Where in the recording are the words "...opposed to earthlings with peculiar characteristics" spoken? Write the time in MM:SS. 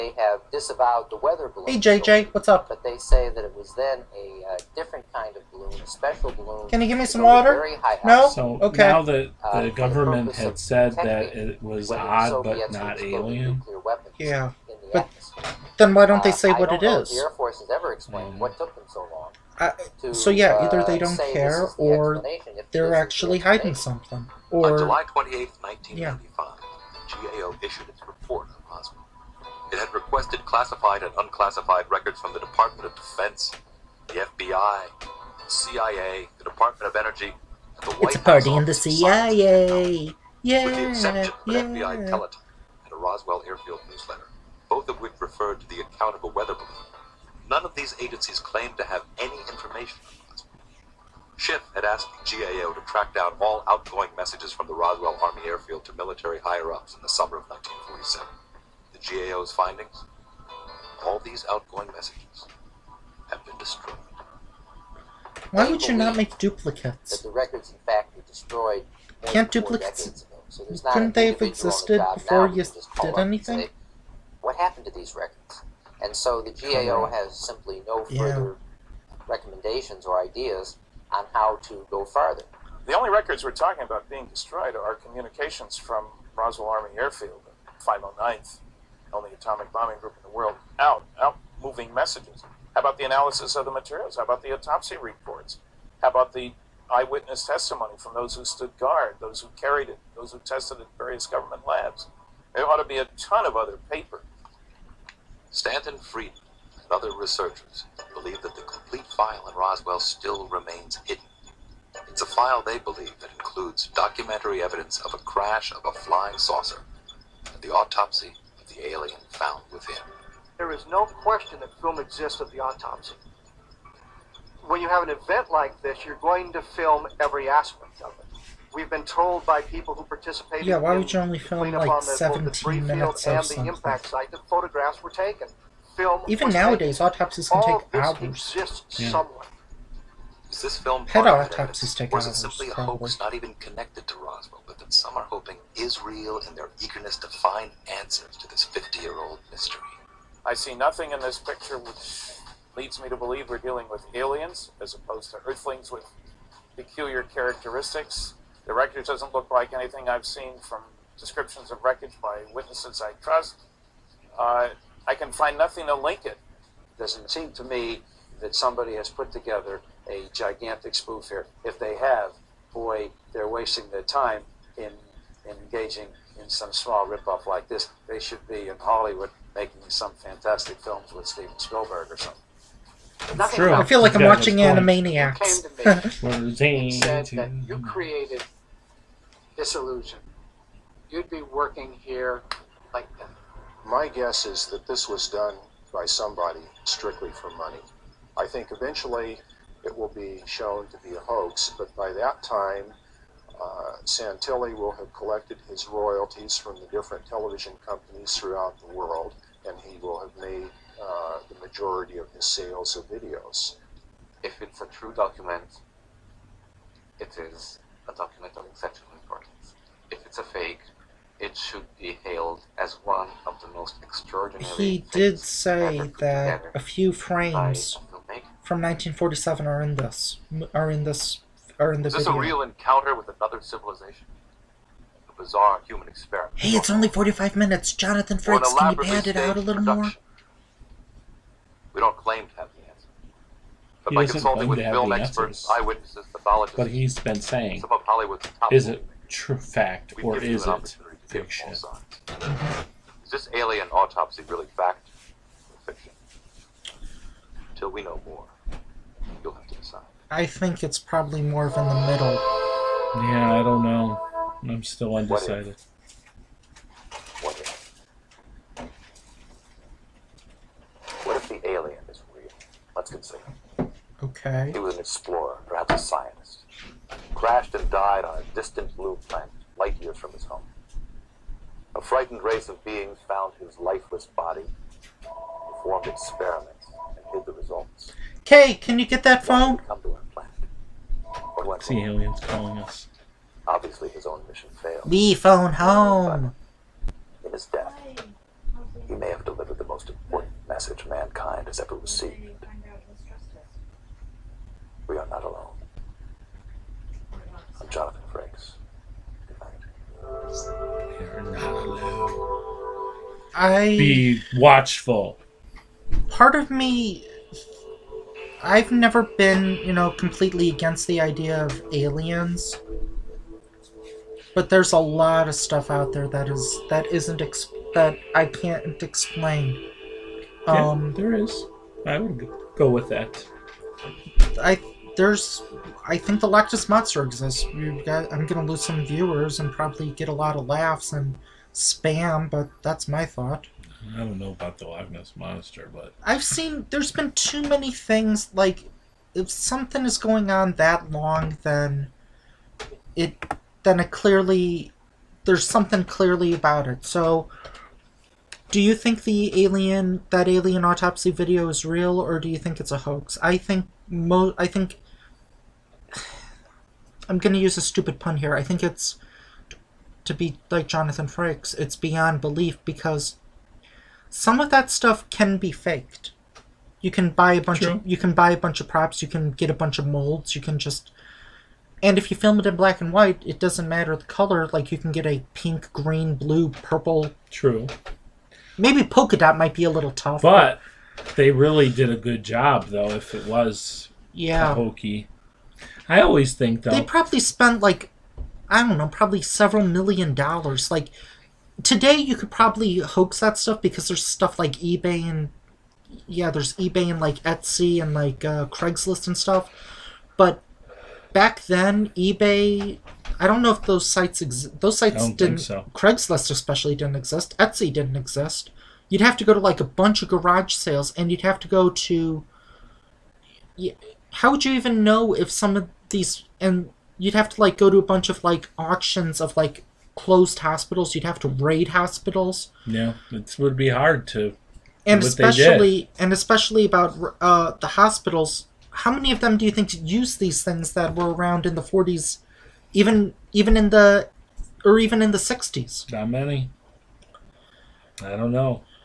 02:34.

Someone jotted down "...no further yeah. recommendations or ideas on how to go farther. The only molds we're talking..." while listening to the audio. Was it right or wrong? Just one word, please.
wrong.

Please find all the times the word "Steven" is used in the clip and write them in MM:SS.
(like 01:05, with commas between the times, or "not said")
03:01.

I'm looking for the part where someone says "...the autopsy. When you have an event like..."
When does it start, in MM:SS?
02:02.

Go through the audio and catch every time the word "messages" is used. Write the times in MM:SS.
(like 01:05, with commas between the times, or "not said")
00:54, 01:01, 01:31, 05:00.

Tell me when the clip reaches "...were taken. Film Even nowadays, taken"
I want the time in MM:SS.
02:15.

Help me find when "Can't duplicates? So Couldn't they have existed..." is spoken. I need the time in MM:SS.
01:09.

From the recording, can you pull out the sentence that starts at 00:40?
Yeah, With the exception of yeah.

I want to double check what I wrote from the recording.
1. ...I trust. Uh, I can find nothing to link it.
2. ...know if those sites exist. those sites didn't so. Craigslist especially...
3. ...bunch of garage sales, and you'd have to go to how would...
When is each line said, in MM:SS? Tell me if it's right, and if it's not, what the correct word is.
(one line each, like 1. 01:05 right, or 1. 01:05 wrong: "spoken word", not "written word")
1. 02:43 right
2. 06:53 right
3. 06:59 right.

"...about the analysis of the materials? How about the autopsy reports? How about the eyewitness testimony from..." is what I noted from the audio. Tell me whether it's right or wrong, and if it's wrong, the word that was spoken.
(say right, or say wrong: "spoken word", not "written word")
right.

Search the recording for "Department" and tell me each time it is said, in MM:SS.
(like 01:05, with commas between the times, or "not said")
00:32, 00:36.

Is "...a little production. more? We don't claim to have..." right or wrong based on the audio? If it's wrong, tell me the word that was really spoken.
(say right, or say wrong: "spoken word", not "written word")
right.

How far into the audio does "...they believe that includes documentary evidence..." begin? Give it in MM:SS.
01:52.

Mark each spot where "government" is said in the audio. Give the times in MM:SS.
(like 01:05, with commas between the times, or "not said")
00:09, 01:41.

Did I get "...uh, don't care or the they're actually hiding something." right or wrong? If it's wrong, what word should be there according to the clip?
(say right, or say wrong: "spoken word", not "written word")
right.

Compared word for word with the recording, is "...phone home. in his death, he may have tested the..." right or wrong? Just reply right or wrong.
wrong.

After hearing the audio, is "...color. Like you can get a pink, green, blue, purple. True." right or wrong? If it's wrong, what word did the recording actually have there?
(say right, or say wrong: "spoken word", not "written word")
right.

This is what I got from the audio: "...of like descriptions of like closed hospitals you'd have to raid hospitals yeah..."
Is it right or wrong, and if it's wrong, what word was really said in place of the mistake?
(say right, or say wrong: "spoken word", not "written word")
wrong: "auctions", not "descriptions".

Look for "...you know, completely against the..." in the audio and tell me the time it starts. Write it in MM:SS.
05:19.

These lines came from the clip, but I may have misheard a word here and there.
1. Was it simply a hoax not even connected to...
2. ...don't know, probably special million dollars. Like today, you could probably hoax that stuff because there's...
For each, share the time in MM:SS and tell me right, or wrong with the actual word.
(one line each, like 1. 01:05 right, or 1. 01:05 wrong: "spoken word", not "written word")
1. 02:22 right
2. 06:38 wrong: "several", not "special".